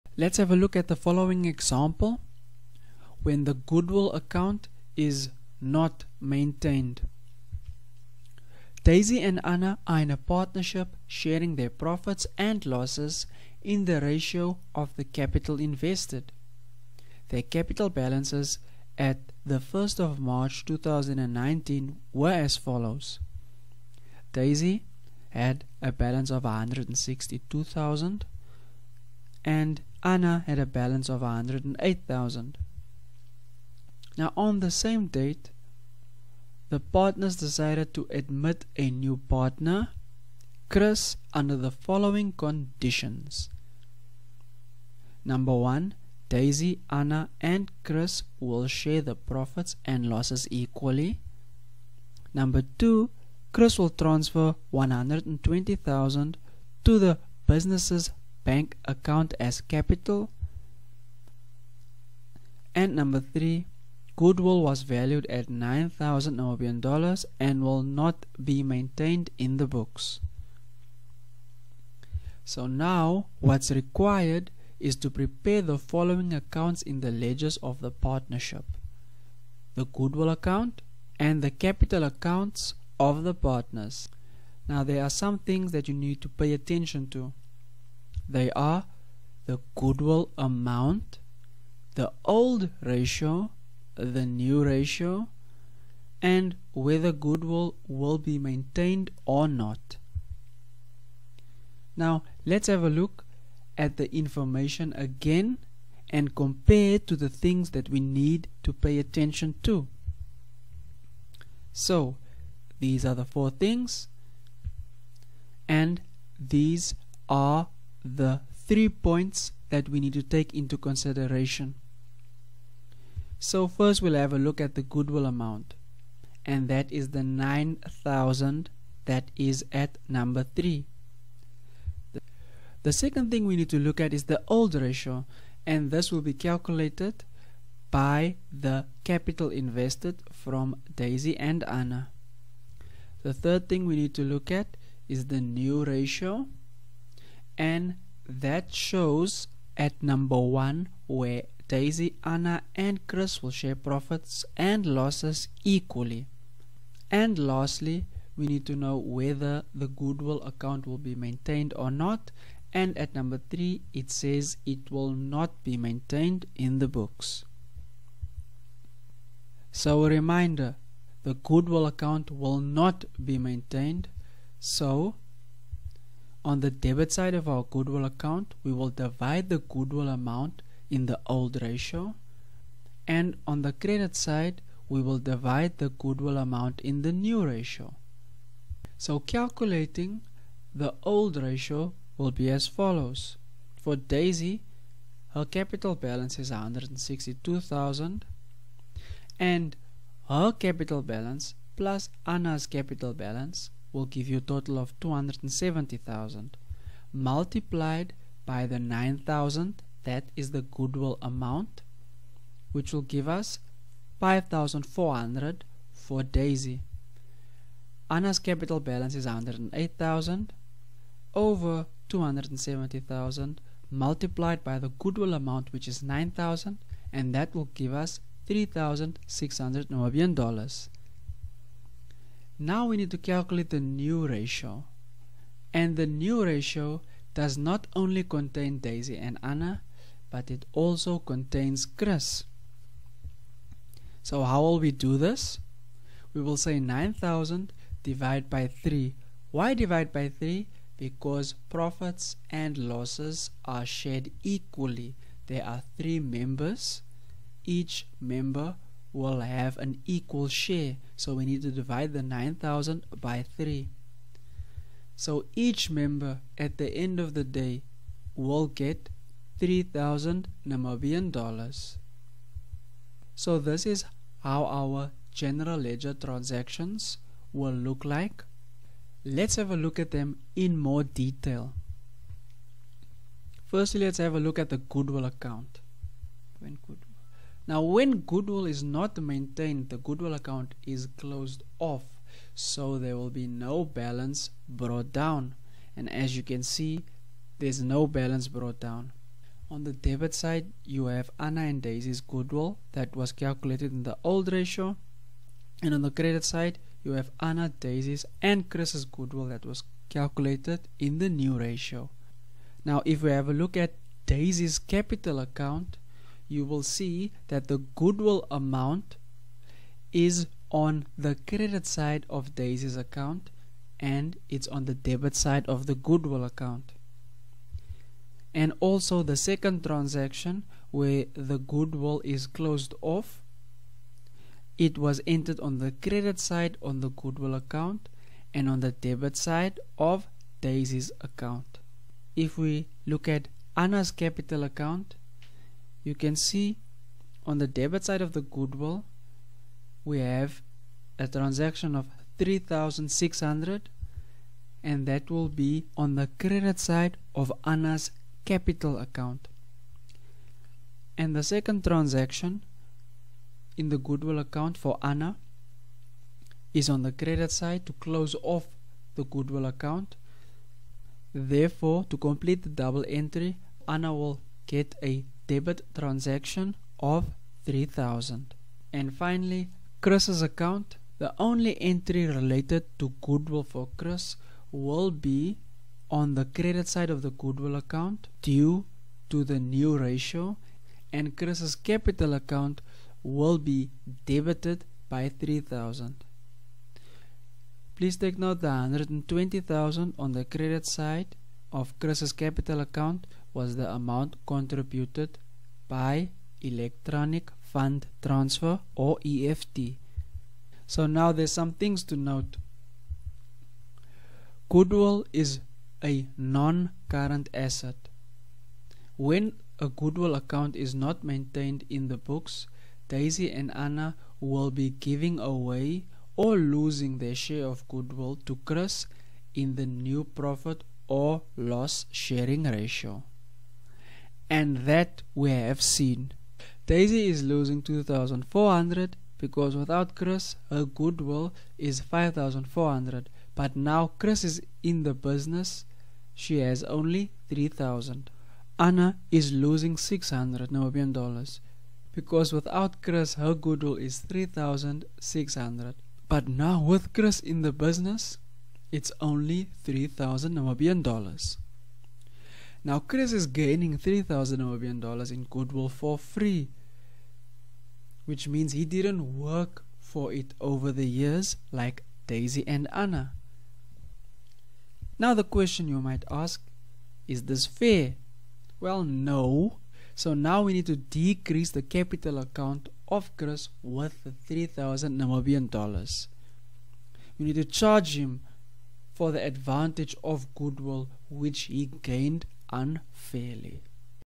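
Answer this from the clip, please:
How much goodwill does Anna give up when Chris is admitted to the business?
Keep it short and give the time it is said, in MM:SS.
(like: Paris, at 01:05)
600, at 07:29.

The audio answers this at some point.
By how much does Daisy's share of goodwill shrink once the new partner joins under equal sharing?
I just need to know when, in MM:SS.
07:17.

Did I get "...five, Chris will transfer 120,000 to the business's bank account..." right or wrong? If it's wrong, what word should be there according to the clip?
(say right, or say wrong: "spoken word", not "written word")
wrong: "two", not "five".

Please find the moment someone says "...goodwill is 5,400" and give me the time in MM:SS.
07:20.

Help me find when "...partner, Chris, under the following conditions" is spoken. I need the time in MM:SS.
00:39.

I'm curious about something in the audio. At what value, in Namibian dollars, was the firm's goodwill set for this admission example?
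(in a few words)
9000.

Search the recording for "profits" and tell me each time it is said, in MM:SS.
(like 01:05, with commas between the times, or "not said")
00:11, 00:49, 02:33, 04:11, 07:10.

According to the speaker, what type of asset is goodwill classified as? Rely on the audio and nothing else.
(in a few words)
non-current asset.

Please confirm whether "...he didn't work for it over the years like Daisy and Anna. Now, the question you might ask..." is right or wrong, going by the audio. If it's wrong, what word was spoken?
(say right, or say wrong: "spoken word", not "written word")
right.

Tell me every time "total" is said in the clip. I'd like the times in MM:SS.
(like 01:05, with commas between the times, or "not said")
03:24.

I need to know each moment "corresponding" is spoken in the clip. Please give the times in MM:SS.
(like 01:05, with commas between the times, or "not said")
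not said.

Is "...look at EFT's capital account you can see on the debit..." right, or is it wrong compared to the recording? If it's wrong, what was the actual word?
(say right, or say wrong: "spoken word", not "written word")
wrong: "Anna", not "EFT".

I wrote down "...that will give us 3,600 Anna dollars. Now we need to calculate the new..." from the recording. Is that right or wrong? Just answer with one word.
wrong.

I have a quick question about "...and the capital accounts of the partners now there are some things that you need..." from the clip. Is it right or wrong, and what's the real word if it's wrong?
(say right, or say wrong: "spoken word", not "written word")
right.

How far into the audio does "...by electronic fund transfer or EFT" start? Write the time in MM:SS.
06:45.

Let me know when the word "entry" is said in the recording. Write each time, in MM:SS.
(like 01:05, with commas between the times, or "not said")
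06:13, 06:21.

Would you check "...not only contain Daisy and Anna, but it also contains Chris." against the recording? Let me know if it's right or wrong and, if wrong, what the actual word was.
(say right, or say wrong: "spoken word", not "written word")
right.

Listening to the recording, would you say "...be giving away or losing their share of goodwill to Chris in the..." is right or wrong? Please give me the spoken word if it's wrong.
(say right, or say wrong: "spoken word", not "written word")
right.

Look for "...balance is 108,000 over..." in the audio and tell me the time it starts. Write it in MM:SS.
03:38.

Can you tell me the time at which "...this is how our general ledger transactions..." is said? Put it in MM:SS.
04:33.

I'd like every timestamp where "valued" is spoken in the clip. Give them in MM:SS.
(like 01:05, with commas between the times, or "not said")
01:04.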